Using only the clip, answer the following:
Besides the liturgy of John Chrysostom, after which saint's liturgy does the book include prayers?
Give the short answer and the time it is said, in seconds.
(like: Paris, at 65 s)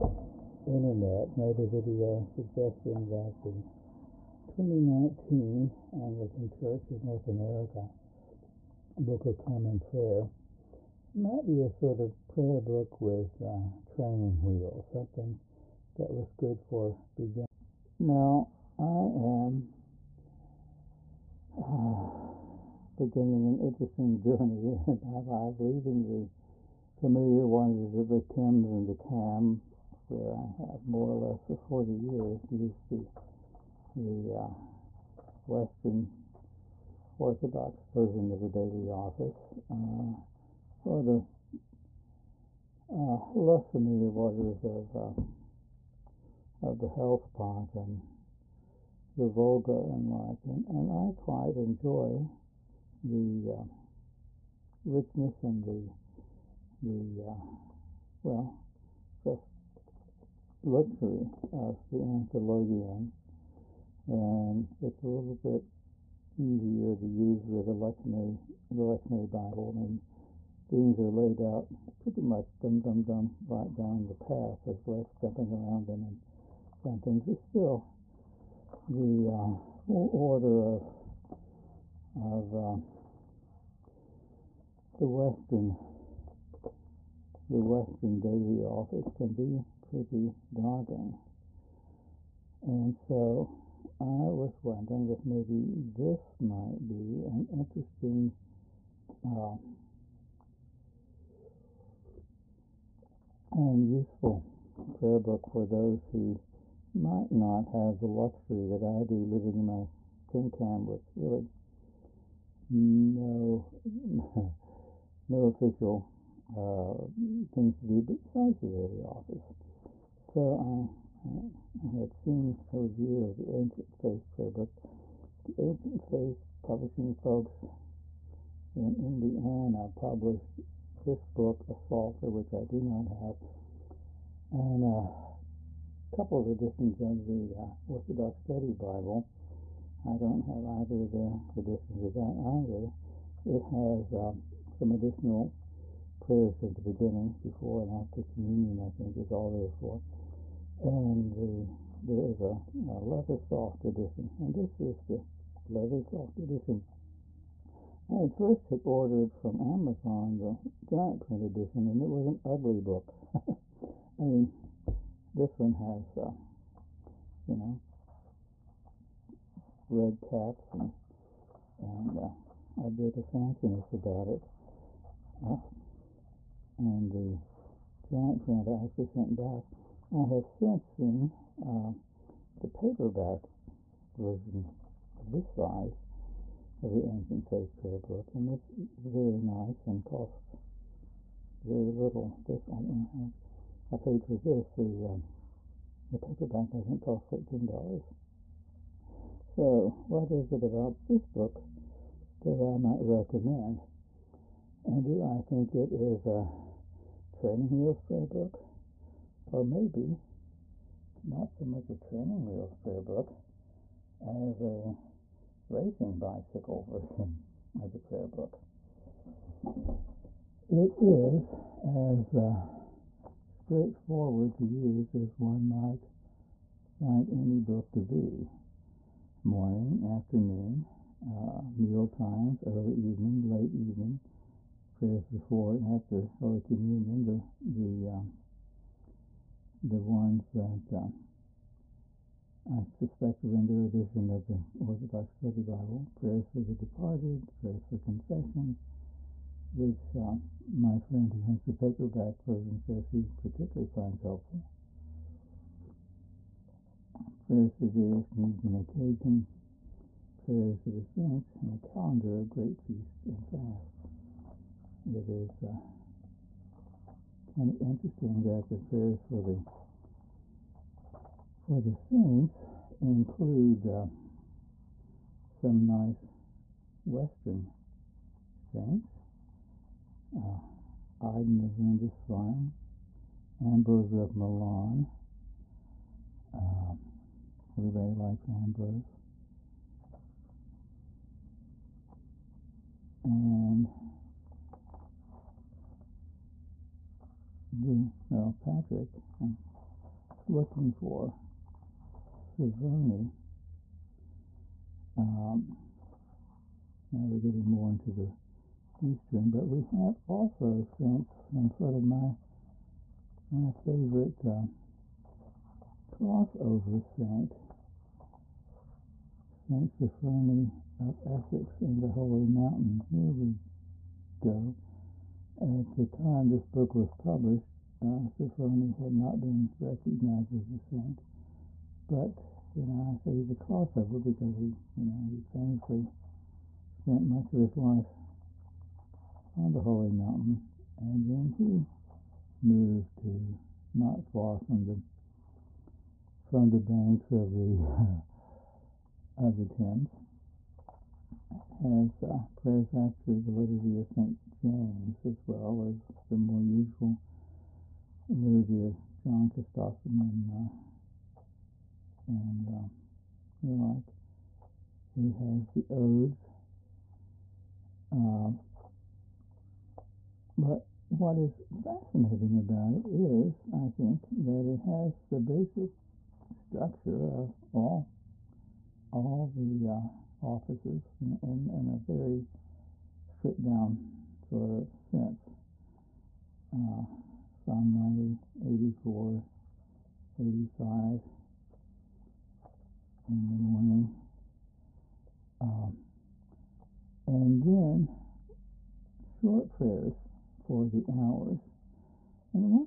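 Saint James, at 354 s.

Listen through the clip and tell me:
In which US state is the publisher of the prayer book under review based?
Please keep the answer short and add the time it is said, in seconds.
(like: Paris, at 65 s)
Indiana, at 128 s.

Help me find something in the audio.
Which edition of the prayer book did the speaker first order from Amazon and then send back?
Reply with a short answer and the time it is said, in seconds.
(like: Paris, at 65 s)
Giant print edition, at 160 s.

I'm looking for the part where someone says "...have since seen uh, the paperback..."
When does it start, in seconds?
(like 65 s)
180 s.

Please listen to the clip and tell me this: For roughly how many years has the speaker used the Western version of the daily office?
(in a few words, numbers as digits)
40.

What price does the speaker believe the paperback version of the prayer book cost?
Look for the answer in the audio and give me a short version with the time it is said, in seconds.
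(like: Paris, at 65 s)
$13, at 197 s.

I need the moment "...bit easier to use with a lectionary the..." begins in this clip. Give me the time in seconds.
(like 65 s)
65 s.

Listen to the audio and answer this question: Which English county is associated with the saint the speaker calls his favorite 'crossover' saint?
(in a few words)
Essex.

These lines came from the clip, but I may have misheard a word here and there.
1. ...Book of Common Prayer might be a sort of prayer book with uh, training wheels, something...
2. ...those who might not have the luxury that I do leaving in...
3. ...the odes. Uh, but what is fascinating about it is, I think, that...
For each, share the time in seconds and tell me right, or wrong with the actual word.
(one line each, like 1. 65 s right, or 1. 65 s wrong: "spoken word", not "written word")
1. 8 s right
2. 105 s wrong: "living", not "leaving"
3. 365 s right.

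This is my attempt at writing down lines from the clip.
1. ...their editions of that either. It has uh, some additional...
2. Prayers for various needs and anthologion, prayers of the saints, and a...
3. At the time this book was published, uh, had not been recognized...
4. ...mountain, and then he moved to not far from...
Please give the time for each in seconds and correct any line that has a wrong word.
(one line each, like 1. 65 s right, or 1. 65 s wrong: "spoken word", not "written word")
1. 141 s right
2. 257 s wrong: "occasion", not "anthologion"
3. 325 s right
4. 340 s right.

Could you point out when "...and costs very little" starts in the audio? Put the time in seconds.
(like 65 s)
189 s.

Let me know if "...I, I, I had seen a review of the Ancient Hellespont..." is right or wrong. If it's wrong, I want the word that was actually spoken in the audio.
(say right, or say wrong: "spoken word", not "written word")
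wrong: "Faith", not "Hellespont".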